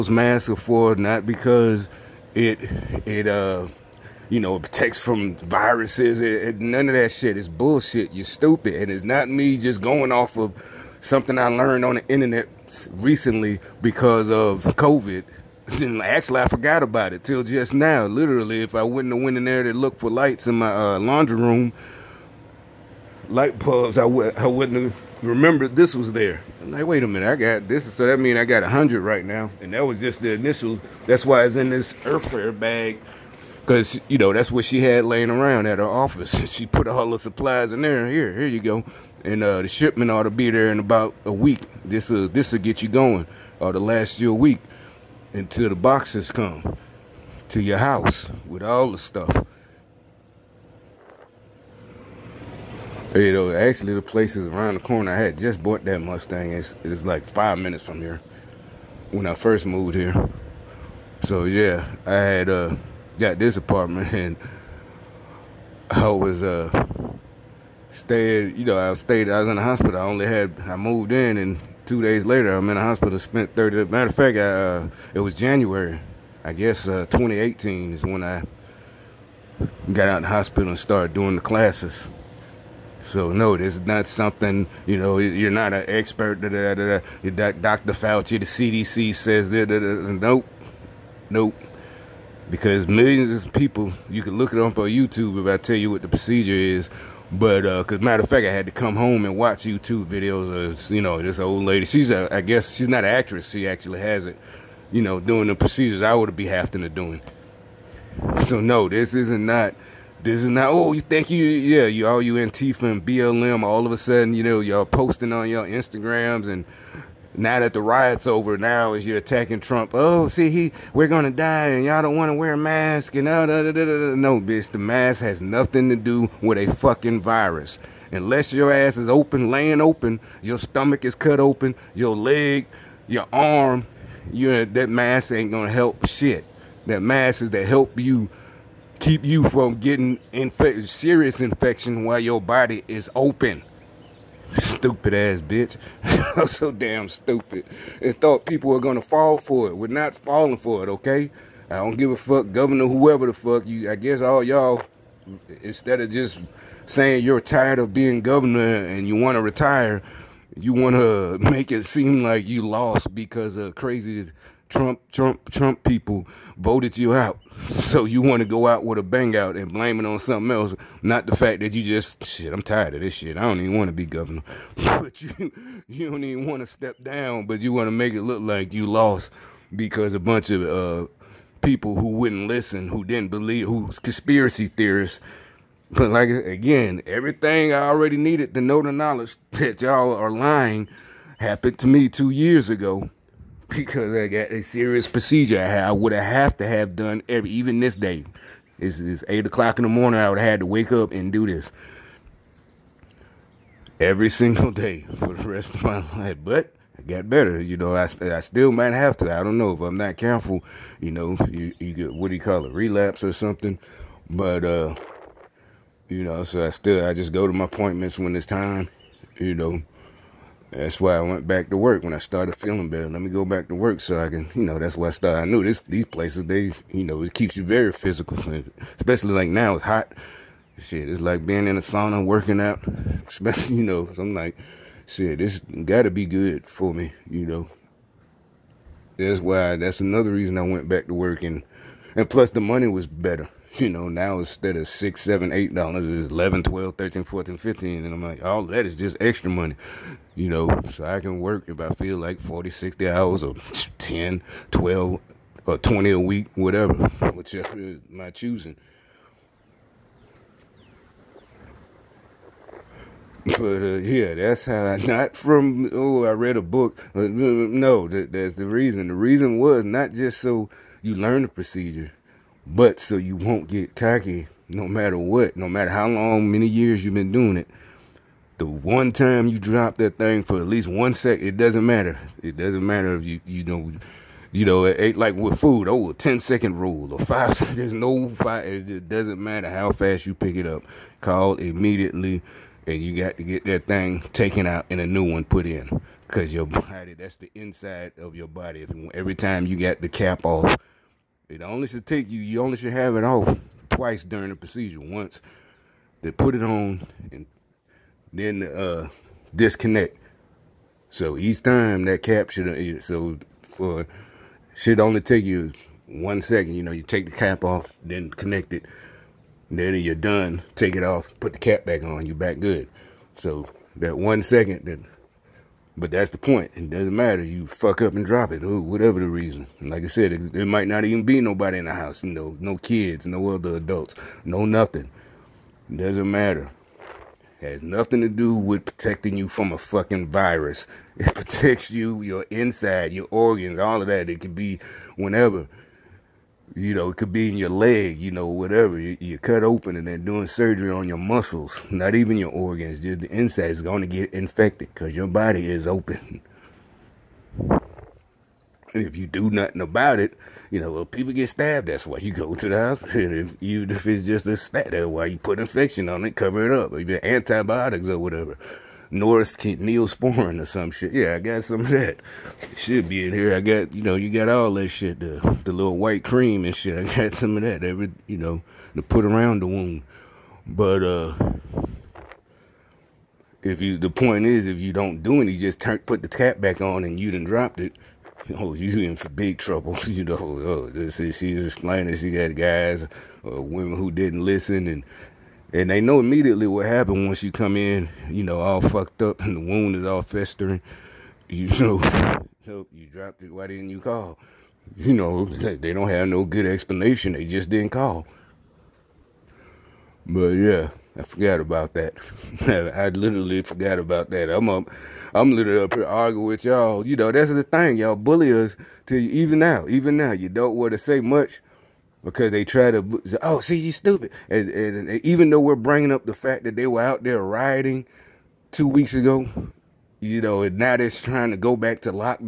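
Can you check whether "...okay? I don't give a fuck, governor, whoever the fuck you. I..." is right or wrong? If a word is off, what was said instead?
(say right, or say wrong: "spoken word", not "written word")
right.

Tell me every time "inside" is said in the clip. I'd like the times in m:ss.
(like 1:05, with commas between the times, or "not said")
4:57, 5:42, 5:53.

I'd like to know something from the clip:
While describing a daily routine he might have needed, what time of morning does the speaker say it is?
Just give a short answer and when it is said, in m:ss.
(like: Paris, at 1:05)
8 o'clock, at 3:19.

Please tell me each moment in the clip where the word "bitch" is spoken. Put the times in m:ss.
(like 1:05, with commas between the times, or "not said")
2:04, 2:25.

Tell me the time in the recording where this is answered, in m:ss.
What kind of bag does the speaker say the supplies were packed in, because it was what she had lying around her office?
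0:32.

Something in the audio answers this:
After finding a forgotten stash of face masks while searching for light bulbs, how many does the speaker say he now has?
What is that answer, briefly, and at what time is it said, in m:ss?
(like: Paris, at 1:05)
100, at 0:28.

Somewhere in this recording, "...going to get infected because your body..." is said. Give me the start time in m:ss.
5:53.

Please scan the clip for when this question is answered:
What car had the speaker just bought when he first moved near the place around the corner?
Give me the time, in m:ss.
0:56.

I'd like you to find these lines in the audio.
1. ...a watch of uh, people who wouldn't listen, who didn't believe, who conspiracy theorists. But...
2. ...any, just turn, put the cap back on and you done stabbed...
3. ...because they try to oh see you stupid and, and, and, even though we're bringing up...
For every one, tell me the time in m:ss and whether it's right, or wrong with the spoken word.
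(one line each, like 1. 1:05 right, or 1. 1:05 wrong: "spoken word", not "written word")
1. 3:00 wrong: "bunch", not "watch"
2. 6:25 wrong: "dropped", not "stabbed"
3. 7:02 right.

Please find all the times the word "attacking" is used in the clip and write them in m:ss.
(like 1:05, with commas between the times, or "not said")
1:59.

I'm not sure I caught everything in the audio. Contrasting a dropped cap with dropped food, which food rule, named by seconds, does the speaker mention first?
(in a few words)
10 second rule.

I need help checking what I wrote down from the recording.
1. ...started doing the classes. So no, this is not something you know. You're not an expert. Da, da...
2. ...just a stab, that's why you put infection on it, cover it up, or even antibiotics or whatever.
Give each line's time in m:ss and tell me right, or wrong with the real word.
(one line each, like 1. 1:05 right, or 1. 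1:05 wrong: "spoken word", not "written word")
1. 1:20 right
2. 6:04 right.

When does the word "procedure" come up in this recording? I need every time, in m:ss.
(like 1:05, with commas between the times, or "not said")
1:36, 1:45, 3:15, 4:31, 5:04.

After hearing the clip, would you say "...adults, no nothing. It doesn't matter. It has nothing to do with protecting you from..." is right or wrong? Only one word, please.
right.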